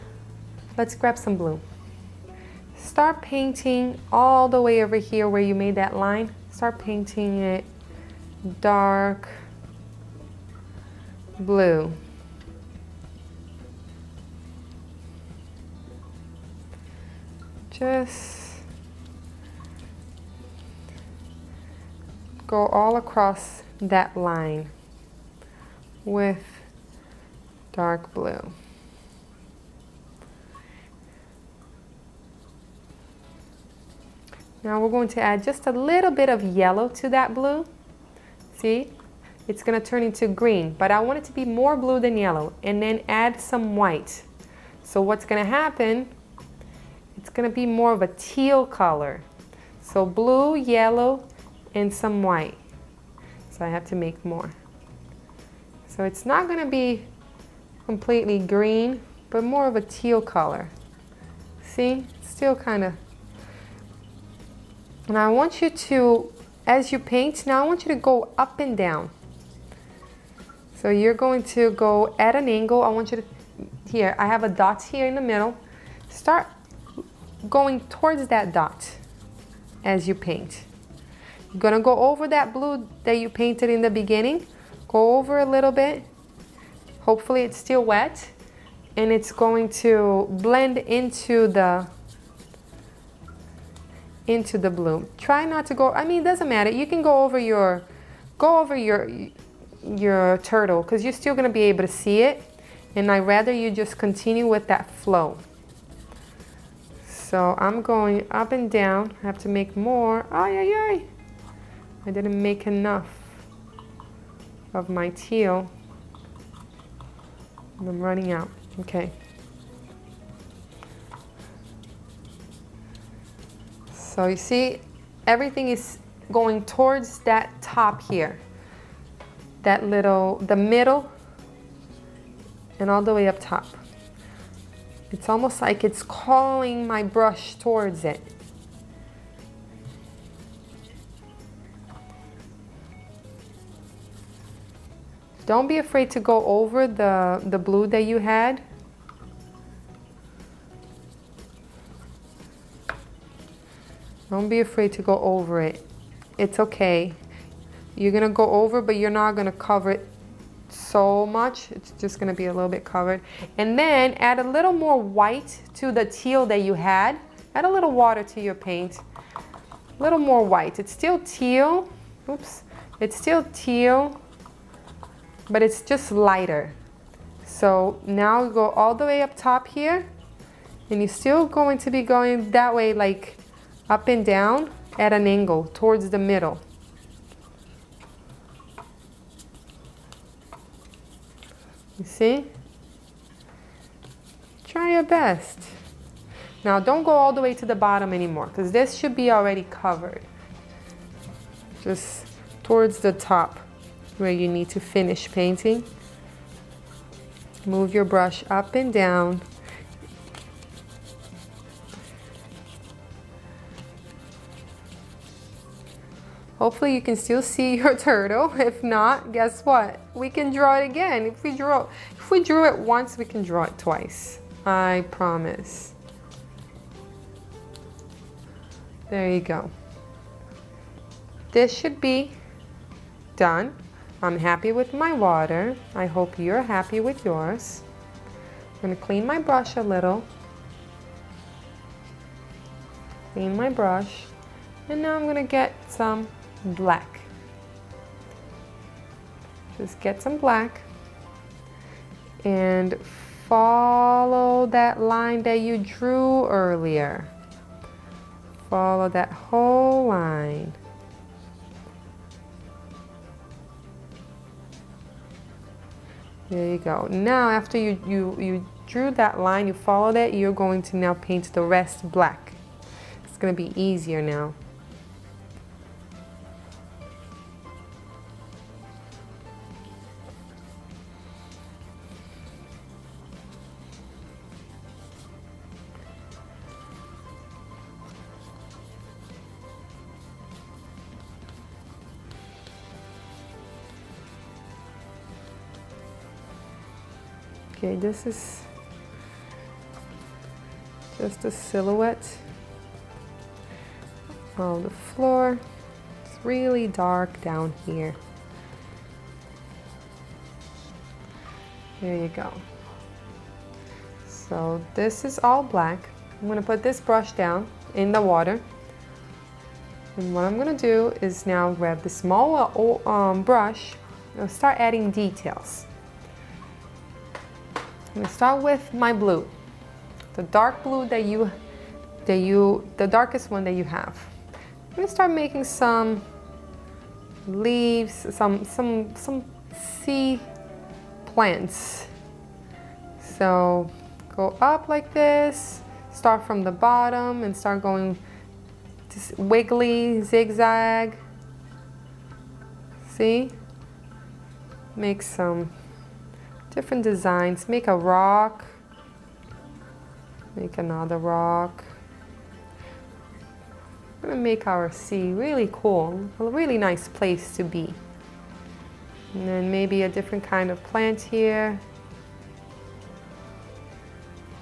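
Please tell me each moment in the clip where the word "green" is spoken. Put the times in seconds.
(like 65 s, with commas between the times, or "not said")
40 s, 58 s.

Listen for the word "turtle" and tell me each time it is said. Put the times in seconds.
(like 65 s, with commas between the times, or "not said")
100 s, 217 s.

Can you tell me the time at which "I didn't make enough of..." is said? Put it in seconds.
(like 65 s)
112 s.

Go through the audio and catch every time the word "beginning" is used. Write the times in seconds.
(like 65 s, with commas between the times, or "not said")
83 s.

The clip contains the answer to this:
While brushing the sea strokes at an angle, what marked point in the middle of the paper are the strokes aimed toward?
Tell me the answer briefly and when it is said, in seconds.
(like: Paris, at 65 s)
a dot, at 74 s.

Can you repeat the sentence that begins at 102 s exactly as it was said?
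And i rather you just continue with that flow.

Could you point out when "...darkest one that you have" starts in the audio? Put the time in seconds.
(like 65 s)
333 s.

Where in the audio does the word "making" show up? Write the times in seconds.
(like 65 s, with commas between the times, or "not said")
335 s.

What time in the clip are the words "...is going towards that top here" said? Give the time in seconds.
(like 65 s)
125 s.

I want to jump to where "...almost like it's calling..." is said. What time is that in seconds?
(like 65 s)
135 s.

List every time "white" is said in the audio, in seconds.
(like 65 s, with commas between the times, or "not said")
43 s, 52 s, 164 s, 170 s.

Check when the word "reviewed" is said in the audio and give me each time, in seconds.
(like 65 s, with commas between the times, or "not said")
not said.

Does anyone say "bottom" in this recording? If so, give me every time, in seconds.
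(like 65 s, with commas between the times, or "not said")
197 s, 346 s.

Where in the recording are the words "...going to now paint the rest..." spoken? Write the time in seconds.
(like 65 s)
270 s.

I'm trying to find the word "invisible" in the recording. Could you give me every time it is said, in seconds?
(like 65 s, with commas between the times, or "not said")
not said.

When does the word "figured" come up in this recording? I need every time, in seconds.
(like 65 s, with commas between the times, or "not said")
not said.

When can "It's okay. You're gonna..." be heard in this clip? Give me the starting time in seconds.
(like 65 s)
156 s.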